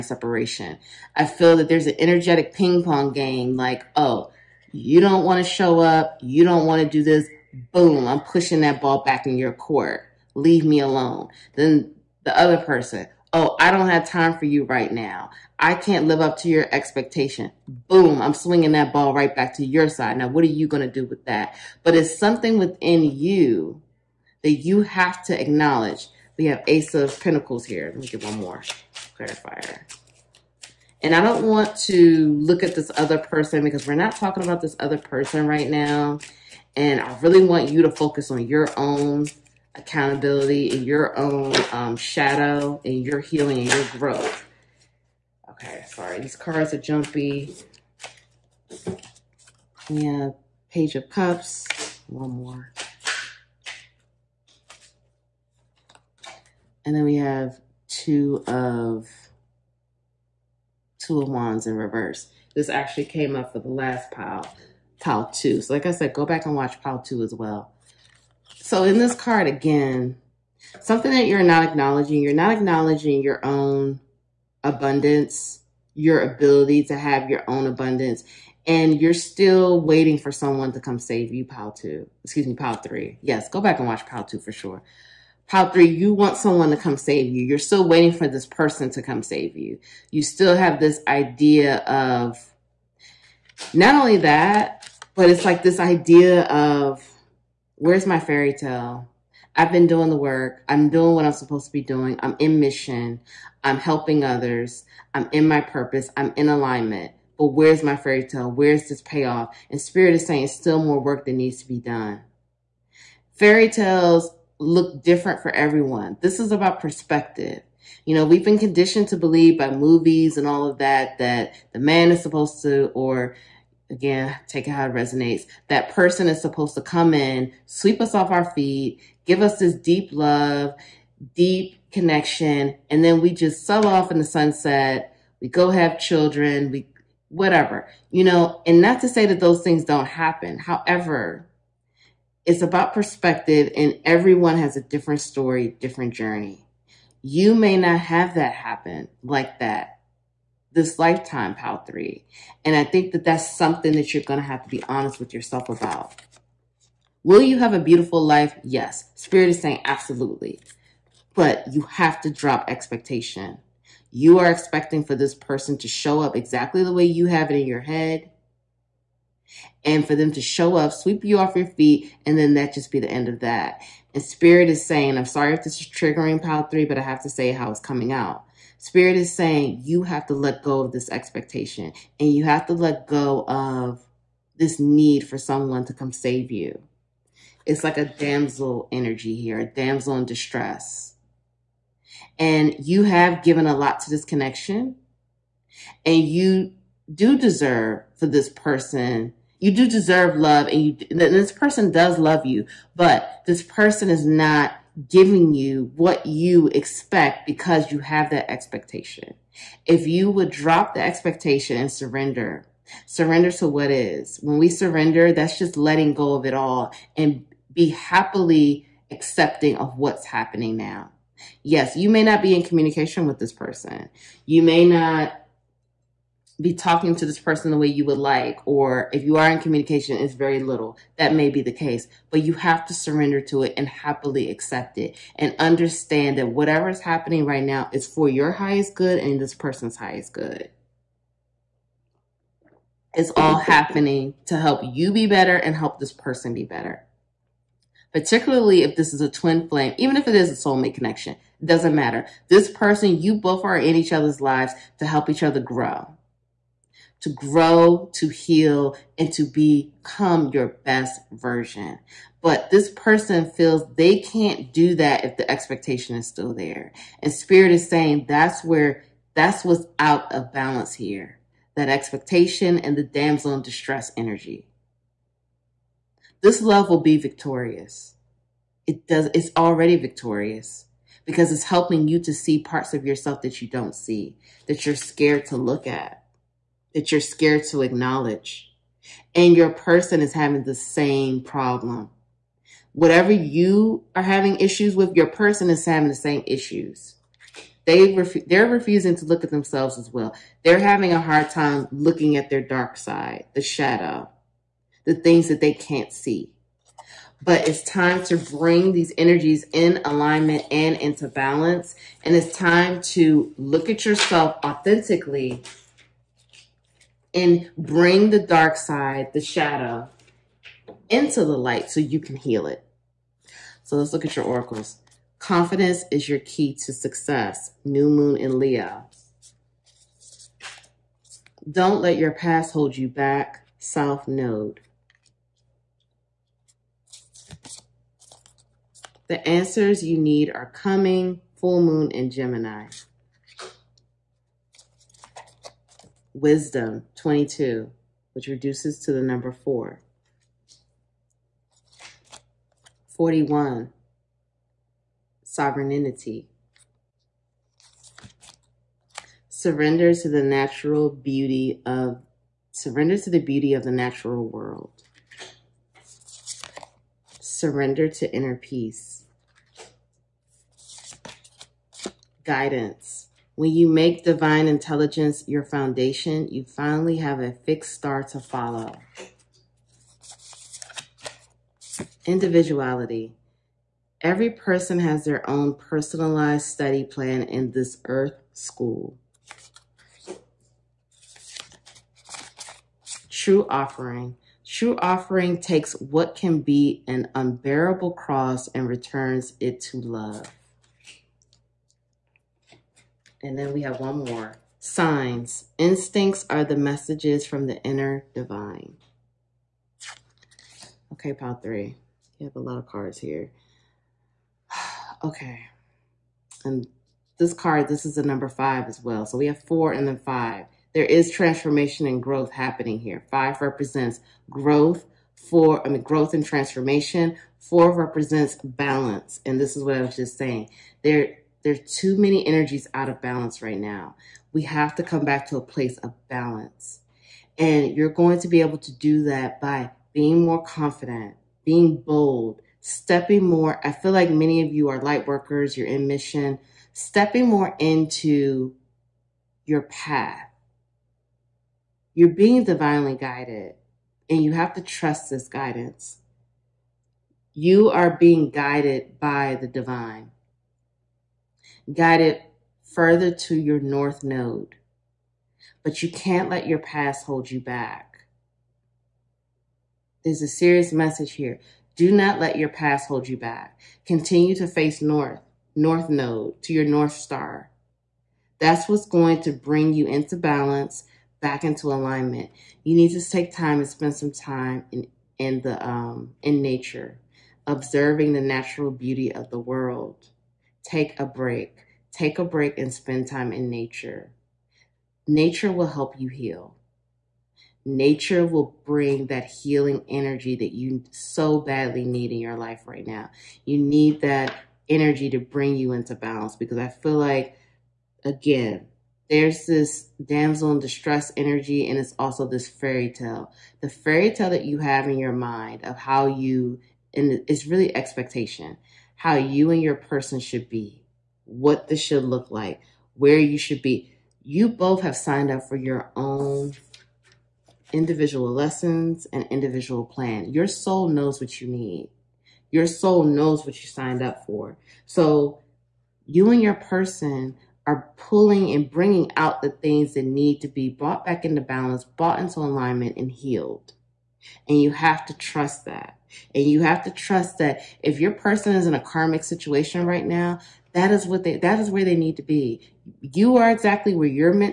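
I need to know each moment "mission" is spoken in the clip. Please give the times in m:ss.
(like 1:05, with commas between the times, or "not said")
1:42, 7:26.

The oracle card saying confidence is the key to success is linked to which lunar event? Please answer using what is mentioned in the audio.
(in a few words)
New moon in Leo.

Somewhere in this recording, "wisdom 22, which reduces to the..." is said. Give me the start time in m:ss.
5:46.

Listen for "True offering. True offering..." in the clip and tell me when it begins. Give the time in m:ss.
6:33.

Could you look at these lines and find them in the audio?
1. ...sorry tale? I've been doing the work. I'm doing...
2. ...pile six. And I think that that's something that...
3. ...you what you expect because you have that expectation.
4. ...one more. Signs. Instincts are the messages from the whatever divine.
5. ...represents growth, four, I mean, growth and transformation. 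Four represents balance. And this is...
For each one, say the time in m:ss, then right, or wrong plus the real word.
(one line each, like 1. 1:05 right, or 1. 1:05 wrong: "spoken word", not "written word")
1. 1:38 wrong: "fairy", not "sorry"
2. 2:31 wrong: "three", not "six"
3. 3:25 right
4. 6:44 wrong: "inner", not "whatever"
5. 7:03 right.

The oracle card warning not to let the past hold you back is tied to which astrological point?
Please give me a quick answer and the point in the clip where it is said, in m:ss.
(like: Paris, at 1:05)
South node, at 5:33.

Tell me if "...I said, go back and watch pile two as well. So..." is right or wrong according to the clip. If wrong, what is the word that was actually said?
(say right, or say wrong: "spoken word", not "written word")
right.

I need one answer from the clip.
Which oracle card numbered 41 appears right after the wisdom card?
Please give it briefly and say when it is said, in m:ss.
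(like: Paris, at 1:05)
Sovereignty, at 5:55.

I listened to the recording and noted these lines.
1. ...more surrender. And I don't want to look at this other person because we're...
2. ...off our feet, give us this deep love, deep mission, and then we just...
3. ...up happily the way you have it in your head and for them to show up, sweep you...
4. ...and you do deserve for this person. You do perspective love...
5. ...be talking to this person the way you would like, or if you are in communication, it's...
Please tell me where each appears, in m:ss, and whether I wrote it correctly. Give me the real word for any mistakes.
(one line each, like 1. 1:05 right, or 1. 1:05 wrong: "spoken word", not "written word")
1. 0:28 wrong: "clarifier", not "surrender"
2. 2:08 wrong: "connection", not "mission"
3. 2:46 wrong: "exactly", not "happily"
4. 3:16 wrong: "deserve", not "perspective"
5. 3:46 right.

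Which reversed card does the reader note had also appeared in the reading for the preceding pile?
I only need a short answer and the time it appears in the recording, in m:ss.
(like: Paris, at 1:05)
Two of Wands, at 1:01.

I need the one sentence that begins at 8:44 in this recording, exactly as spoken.
You both have signed up for your own individual lessons and individual plan.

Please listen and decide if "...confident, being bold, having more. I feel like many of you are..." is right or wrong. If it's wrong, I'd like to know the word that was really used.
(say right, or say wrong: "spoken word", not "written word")
wrong: "stepping", not "having".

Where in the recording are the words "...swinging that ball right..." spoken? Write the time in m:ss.
0:18.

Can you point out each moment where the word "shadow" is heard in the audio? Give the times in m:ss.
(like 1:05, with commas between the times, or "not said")
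0:41, 5:03, 5:19.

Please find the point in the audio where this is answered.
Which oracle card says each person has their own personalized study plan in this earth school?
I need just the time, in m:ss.
6:22.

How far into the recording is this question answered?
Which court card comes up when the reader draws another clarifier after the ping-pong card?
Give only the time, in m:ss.
0:50.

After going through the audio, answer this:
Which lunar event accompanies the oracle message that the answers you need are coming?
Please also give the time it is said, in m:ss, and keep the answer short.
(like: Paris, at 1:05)
Full moon in Gemini, at 5:41.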